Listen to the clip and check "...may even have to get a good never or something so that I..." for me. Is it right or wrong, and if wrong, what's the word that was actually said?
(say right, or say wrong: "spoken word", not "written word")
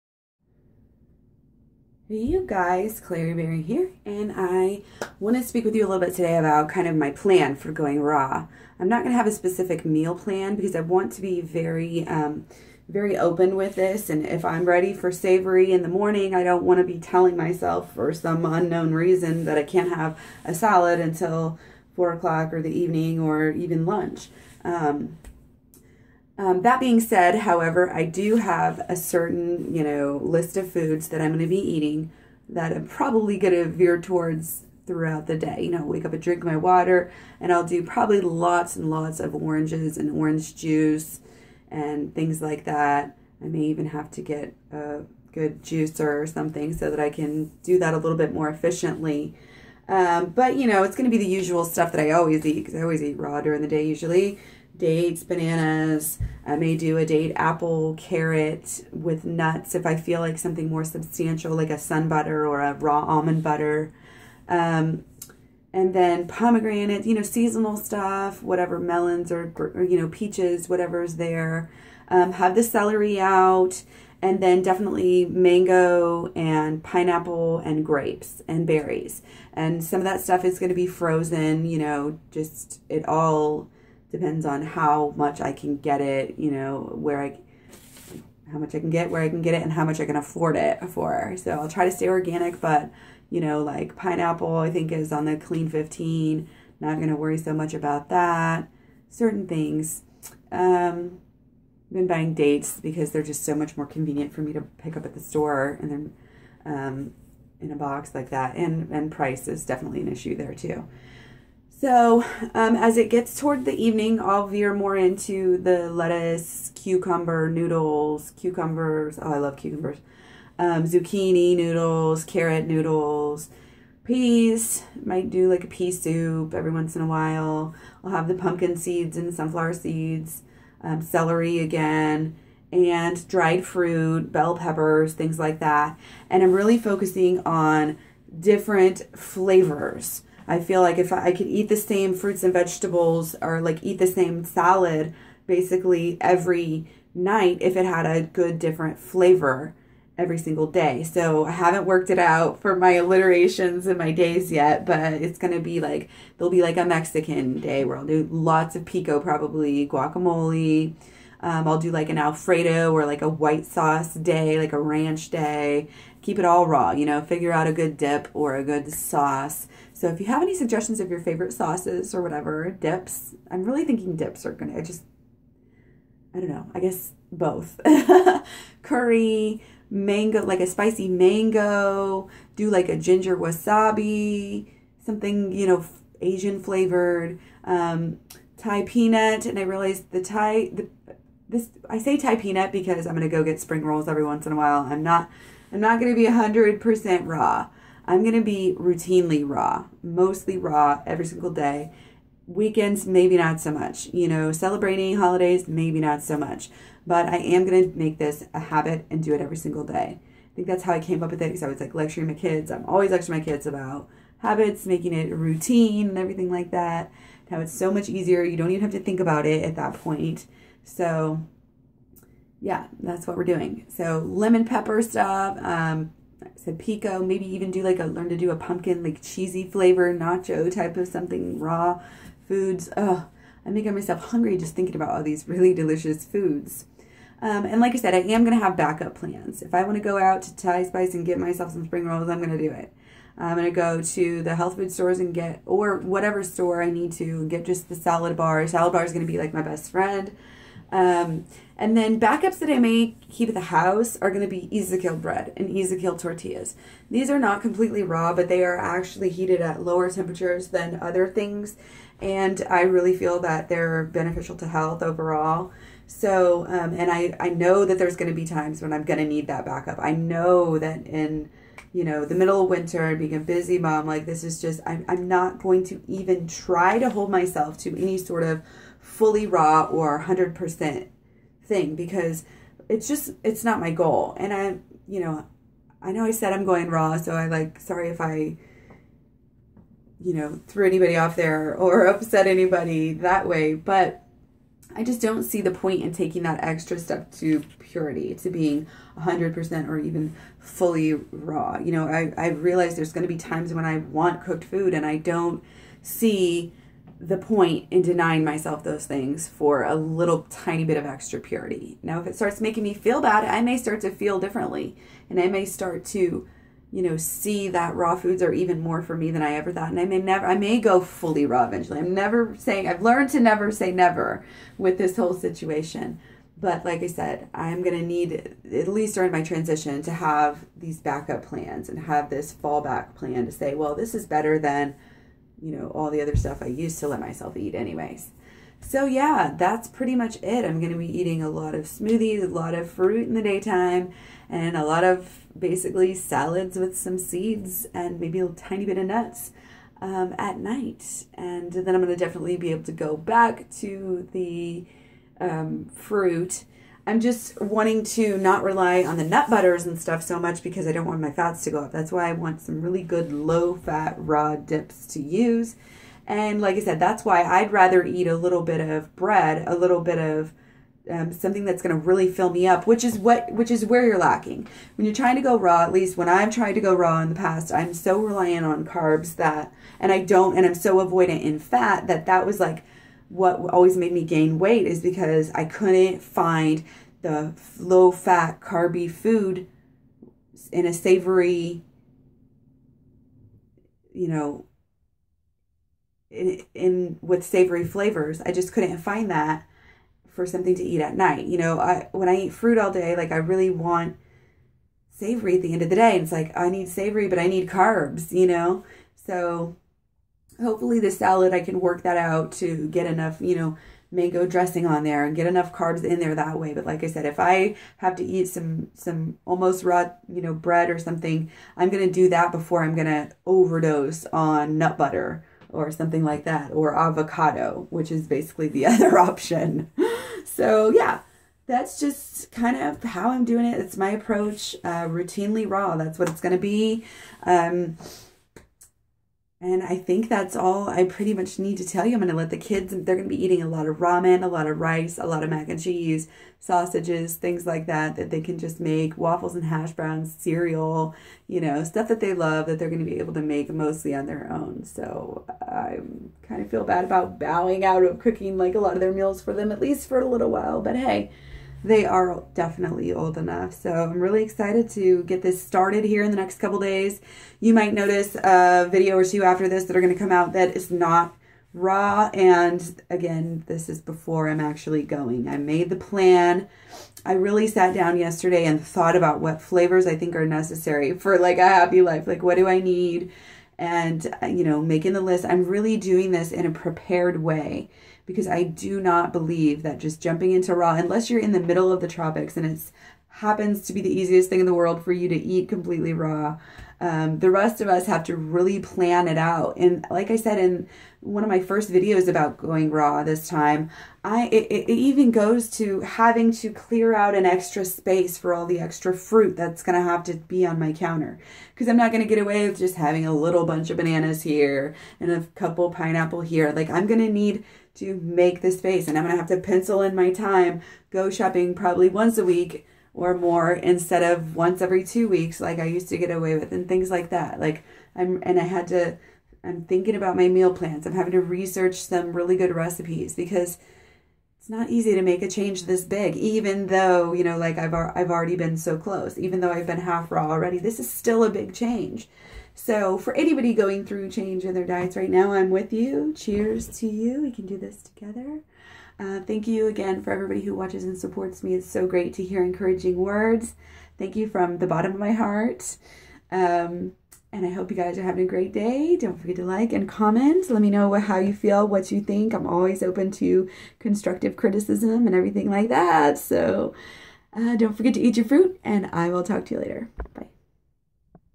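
wrong: "juicer", not "never".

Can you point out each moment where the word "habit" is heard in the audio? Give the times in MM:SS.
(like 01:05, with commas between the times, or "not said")
03:28, 03:34.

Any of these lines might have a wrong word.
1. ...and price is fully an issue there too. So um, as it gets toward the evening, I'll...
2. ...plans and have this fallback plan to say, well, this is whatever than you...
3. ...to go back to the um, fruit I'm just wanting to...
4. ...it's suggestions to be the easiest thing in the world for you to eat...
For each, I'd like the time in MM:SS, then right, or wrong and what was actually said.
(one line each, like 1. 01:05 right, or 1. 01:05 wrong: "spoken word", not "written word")
1. 01:48 wrong: "definitely", not "fully"
2. 05:31 wrong: "better", not "whatever"
3. 05:52 right
4. 08:12 wrong: "happens", not "suggestions".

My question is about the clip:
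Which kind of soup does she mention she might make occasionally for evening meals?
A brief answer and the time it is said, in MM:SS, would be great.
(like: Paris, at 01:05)
Pea soup, at 02:05.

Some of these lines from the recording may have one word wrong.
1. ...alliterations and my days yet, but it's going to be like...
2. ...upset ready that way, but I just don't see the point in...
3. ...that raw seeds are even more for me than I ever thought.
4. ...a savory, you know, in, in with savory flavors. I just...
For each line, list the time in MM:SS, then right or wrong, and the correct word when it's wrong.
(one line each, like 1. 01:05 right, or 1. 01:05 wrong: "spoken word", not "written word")
1. 02:32 right
2. 04:52 wrong: "anybody", not "ready"
3. 05:17 wrong: "foods", not "seeds"
4. 06:30 right.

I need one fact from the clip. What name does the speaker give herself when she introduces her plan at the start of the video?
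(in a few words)
Klairee Berry.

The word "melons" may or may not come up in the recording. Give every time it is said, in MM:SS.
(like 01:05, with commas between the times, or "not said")
01:08.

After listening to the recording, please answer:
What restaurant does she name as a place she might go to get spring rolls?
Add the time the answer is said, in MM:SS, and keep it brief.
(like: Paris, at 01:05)
Thai Spice, at 04:00.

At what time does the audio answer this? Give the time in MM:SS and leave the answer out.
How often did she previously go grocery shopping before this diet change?
08:44.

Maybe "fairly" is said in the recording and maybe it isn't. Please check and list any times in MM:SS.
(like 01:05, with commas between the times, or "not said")
not said.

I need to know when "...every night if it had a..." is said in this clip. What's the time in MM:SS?
02:26.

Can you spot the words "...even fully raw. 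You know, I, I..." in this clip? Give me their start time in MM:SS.
04:59.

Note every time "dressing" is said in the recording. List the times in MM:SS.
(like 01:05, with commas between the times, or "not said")
06:54.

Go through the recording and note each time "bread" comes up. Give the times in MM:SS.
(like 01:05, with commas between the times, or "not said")
04:15, 06:09, 07:00.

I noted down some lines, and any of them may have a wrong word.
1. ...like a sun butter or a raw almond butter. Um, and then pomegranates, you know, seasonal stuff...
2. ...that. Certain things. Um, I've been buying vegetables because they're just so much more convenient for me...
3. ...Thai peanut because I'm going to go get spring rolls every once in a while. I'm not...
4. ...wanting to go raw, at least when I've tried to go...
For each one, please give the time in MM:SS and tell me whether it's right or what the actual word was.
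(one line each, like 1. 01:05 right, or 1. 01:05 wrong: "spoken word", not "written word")
1. 01:01 right
2. 01:38 wrong: "dates", not "vegetables"
3. 03:12 right
4. 06:15 wrong: "trying", not "wanting".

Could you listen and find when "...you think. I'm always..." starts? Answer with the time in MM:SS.
09:22.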